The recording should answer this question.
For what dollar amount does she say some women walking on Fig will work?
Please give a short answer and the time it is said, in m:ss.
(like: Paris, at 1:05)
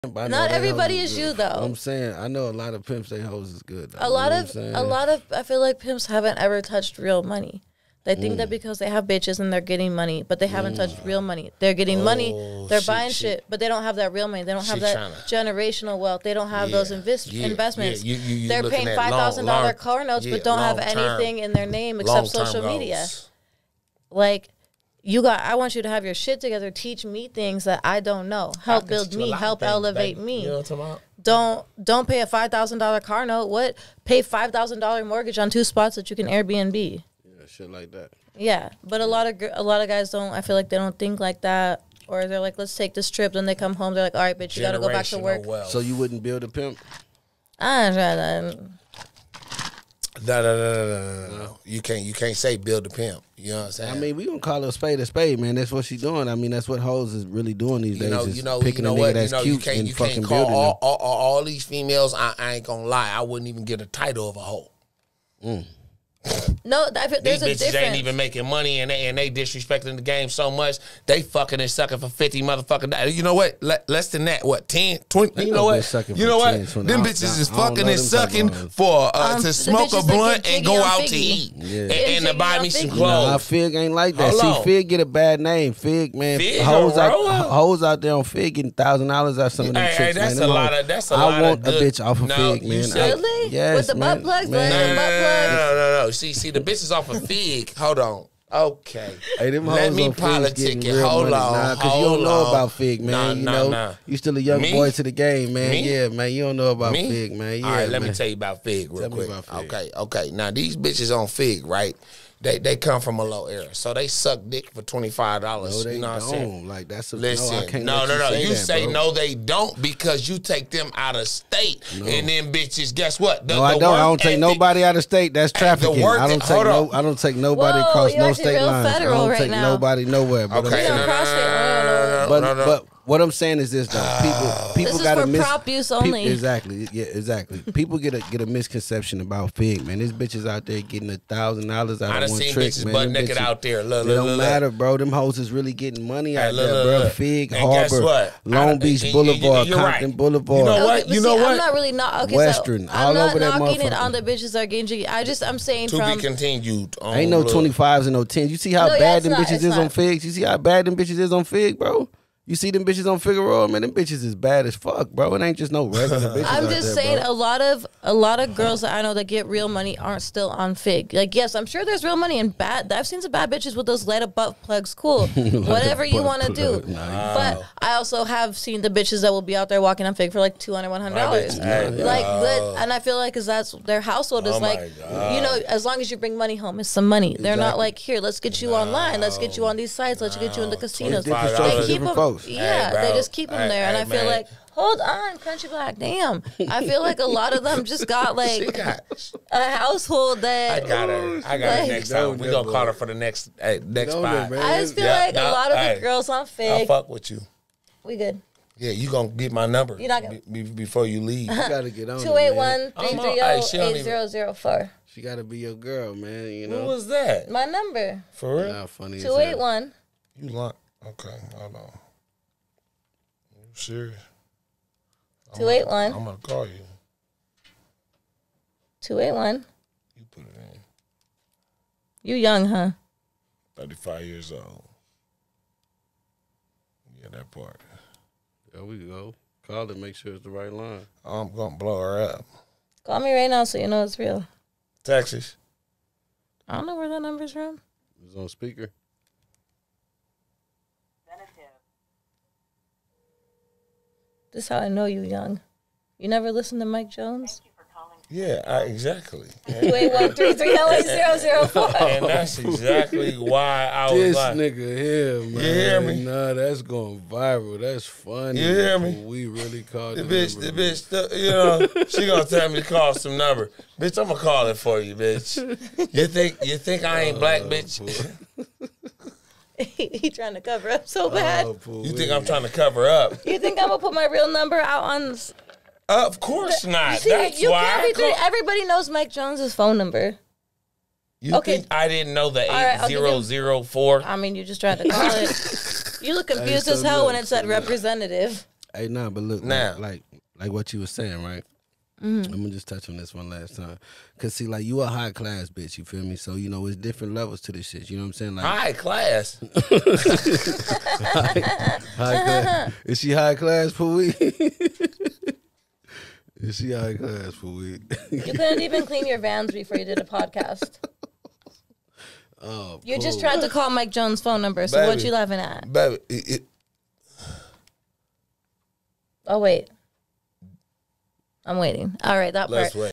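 200 dollars, at 3:00.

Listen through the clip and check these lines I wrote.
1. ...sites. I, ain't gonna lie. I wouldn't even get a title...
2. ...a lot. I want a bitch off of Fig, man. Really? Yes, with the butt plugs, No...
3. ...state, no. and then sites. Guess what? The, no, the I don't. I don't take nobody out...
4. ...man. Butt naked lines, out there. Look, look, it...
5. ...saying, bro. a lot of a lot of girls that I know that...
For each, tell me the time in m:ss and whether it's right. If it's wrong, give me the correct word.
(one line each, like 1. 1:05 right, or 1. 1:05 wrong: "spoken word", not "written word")
1. 1:01 wrong: "females", not "sites"
2. 1:31 right
3. 2:01 wrong: "bitches", not "sites"
4. 2:22 wrong: "bitches", not "lines"
5. 2:47 right.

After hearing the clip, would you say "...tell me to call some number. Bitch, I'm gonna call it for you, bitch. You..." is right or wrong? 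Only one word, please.
right.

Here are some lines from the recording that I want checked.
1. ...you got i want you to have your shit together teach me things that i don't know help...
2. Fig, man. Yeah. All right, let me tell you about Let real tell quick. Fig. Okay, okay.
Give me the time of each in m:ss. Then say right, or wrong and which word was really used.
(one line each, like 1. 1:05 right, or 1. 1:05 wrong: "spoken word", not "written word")
1. 0:25 right
2. 1:47 wrong: "Fig", not "Let".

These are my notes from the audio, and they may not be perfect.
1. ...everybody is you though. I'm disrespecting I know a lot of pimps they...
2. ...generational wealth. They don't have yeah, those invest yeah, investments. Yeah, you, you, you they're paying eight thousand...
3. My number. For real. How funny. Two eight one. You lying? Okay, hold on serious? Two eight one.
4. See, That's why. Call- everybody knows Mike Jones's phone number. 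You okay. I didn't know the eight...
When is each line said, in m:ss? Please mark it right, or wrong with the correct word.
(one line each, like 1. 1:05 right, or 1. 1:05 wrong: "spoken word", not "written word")
1. 0:00 wrong: "saying", not "disrespecting"
2. 0:15 wrong: "five", not "eight"
3. 3:37 right
4. 4:47 right.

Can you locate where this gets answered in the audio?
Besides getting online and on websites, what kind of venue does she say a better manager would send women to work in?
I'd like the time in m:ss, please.
3:10.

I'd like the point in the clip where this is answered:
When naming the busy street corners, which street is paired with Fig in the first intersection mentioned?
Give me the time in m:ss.
2:27.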